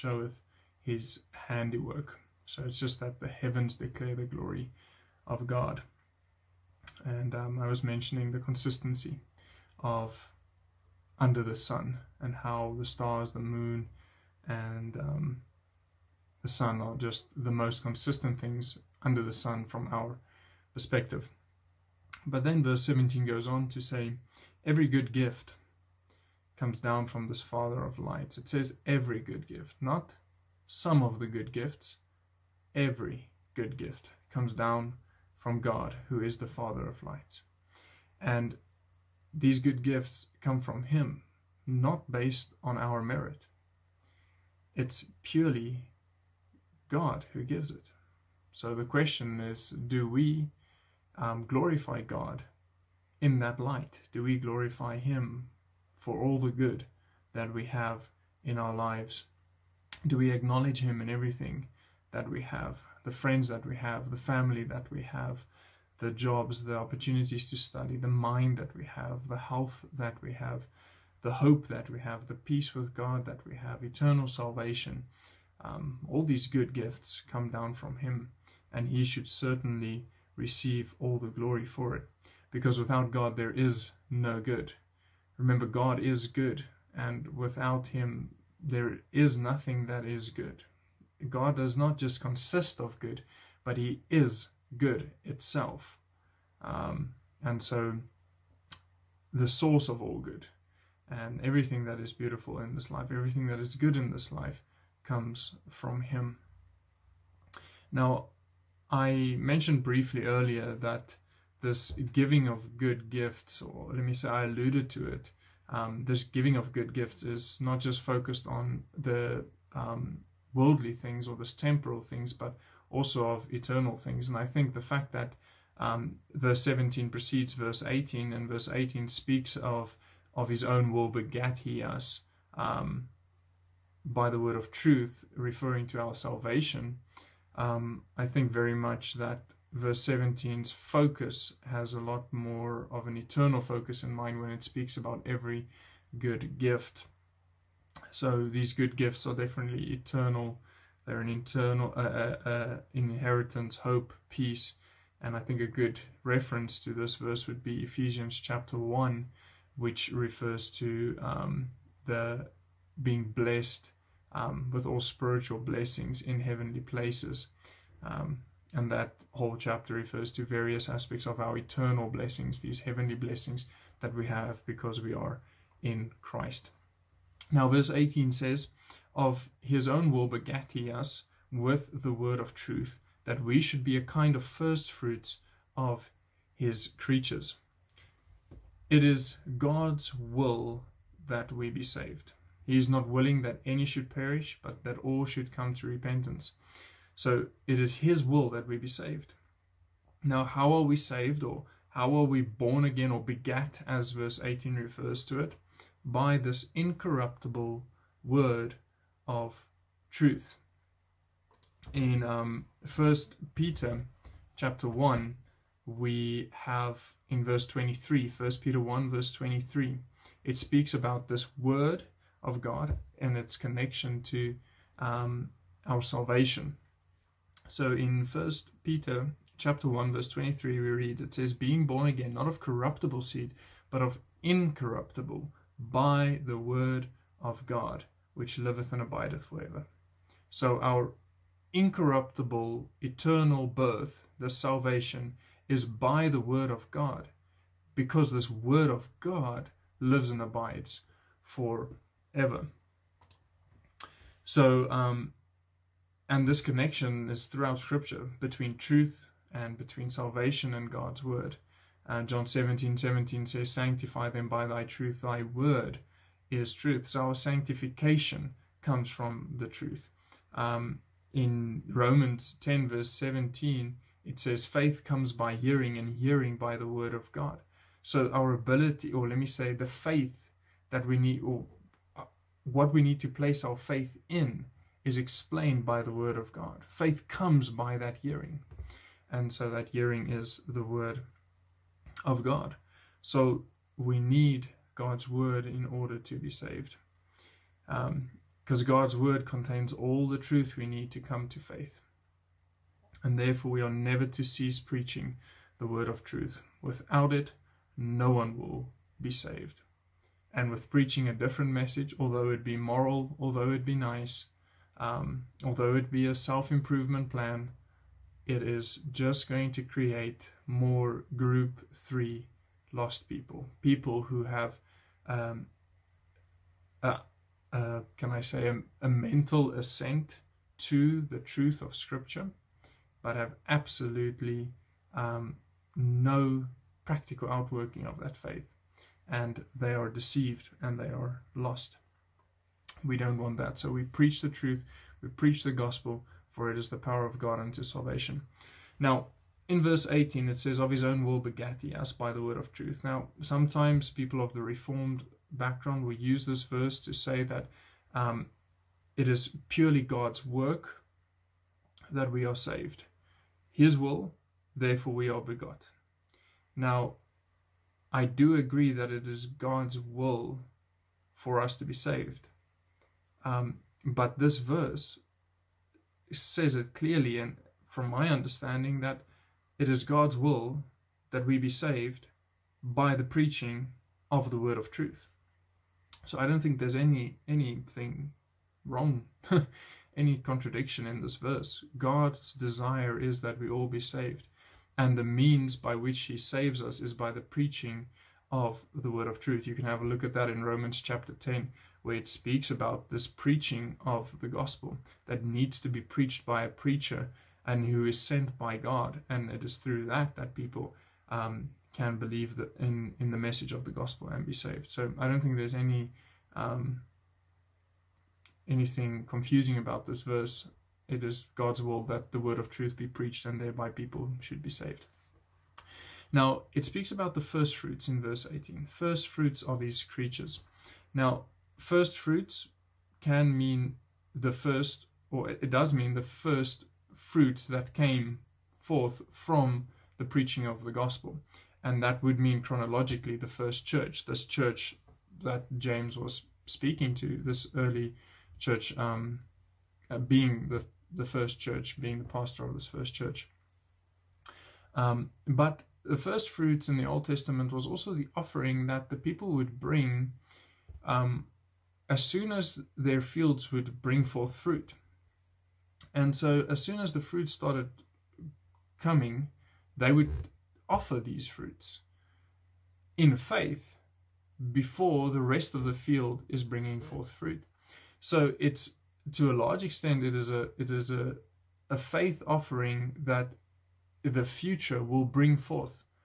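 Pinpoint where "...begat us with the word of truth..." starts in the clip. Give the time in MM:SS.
03:00.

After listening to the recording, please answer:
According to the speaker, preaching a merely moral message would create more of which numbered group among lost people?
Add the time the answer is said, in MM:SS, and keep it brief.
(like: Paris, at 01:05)
Group three, at 05:21.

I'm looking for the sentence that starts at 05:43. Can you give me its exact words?
So we preach the truth, we preach the gospel, for it is the power of God unto salvation.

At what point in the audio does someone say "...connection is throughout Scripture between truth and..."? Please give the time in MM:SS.
04:16.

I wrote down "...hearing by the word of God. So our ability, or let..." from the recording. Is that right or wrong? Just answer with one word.
right.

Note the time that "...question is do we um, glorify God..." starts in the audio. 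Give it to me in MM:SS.
00:48.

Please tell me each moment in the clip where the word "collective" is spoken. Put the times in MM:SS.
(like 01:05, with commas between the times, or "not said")
not said.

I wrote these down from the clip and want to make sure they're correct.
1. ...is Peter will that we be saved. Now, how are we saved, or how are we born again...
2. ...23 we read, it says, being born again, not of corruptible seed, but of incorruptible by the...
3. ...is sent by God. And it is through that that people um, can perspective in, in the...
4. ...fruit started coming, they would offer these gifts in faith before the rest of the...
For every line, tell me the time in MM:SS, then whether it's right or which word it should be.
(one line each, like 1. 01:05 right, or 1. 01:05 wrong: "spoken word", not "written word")
1. 03:17 wrong: "His", not "Peter"
2. 03:50 right
3. 06:48 wrong: "believe", not "perspective"
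4. 07:47 wrong: "fruits", not "gifts".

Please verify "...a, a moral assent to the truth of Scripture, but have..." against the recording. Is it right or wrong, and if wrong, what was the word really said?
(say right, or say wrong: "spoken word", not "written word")
wrong: "mental", not "moral".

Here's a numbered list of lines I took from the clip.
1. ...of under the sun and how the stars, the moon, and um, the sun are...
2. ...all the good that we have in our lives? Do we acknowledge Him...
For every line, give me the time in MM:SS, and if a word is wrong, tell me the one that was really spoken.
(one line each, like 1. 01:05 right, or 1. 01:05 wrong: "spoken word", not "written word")
1. 00:09 right
2. 00:56 right.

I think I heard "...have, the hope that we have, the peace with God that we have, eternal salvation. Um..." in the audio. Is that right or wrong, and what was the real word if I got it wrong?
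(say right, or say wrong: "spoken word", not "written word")
right.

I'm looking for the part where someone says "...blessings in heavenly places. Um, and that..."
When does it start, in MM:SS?
02:45.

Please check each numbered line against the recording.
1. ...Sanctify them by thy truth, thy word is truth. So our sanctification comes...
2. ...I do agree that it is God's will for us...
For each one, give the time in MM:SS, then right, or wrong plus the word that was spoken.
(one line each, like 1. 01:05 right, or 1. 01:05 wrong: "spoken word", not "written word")
1. 04:23 right
2. 06:08 right.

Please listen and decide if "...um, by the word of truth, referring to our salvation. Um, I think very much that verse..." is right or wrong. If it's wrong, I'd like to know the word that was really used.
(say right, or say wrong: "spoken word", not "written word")
right.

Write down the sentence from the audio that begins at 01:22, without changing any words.
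Because without God, there is no good.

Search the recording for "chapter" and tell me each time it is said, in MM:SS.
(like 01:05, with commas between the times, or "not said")
02:38, 02:49, 03:34, 03:49, 06:40.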